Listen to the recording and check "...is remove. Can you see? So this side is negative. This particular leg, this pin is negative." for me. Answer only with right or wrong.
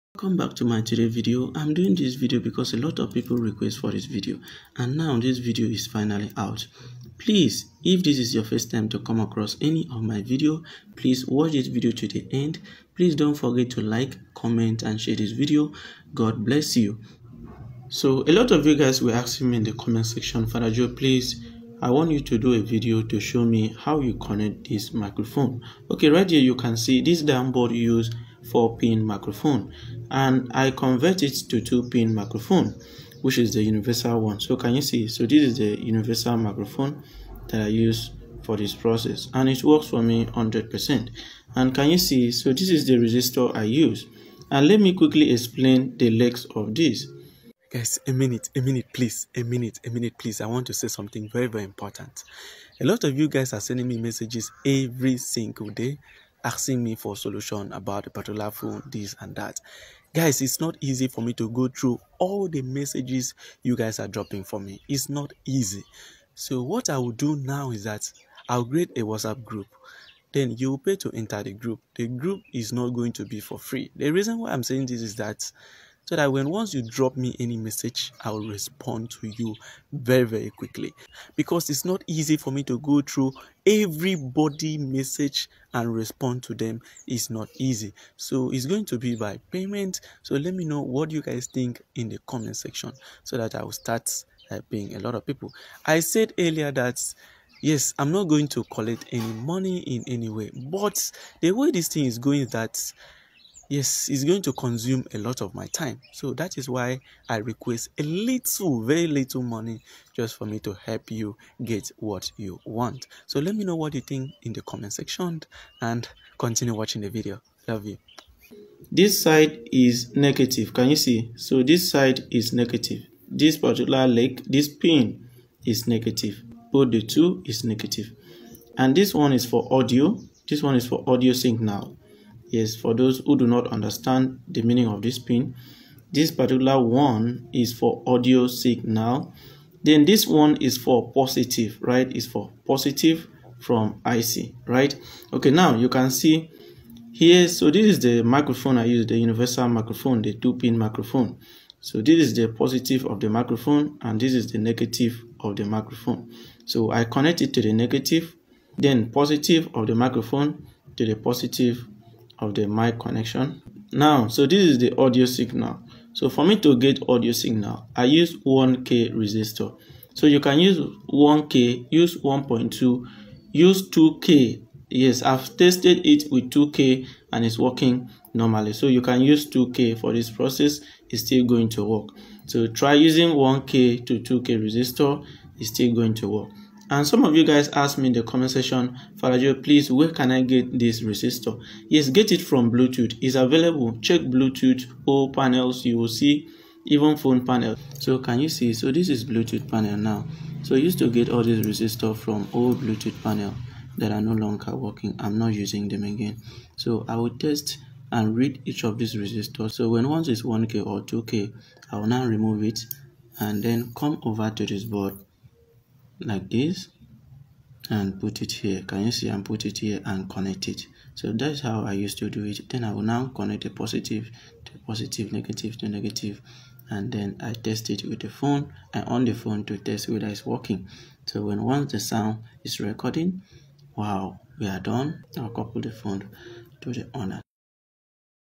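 wrong.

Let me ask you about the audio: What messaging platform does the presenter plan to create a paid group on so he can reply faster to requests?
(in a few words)
WhatsApp.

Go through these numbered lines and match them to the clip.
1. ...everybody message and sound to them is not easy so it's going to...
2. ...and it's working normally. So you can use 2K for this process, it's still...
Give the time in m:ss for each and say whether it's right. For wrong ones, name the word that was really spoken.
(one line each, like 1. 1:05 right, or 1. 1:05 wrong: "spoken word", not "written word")
1. 1:23 wrong: "respond", not "sound"
2. 2:57 right.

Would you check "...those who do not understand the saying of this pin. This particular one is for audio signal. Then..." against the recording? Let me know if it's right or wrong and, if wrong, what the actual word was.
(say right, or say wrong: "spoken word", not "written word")
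wrong: "meaning", not "saying".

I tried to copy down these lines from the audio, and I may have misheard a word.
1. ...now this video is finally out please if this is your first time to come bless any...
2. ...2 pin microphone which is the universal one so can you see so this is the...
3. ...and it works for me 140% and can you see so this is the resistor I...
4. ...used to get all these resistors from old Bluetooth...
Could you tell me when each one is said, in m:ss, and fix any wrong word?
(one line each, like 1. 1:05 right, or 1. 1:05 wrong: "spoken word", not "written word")
1. 0:04 wrong: "across", not "bless"
2. 0:31 right
3. 0:39 wrong: "100", not "140"
4. 3:20 right.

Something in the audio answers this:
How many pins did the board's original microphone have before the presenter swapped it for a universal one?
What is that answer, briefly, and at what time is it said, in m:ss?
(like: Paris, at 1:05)
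4 pin, at 0:28.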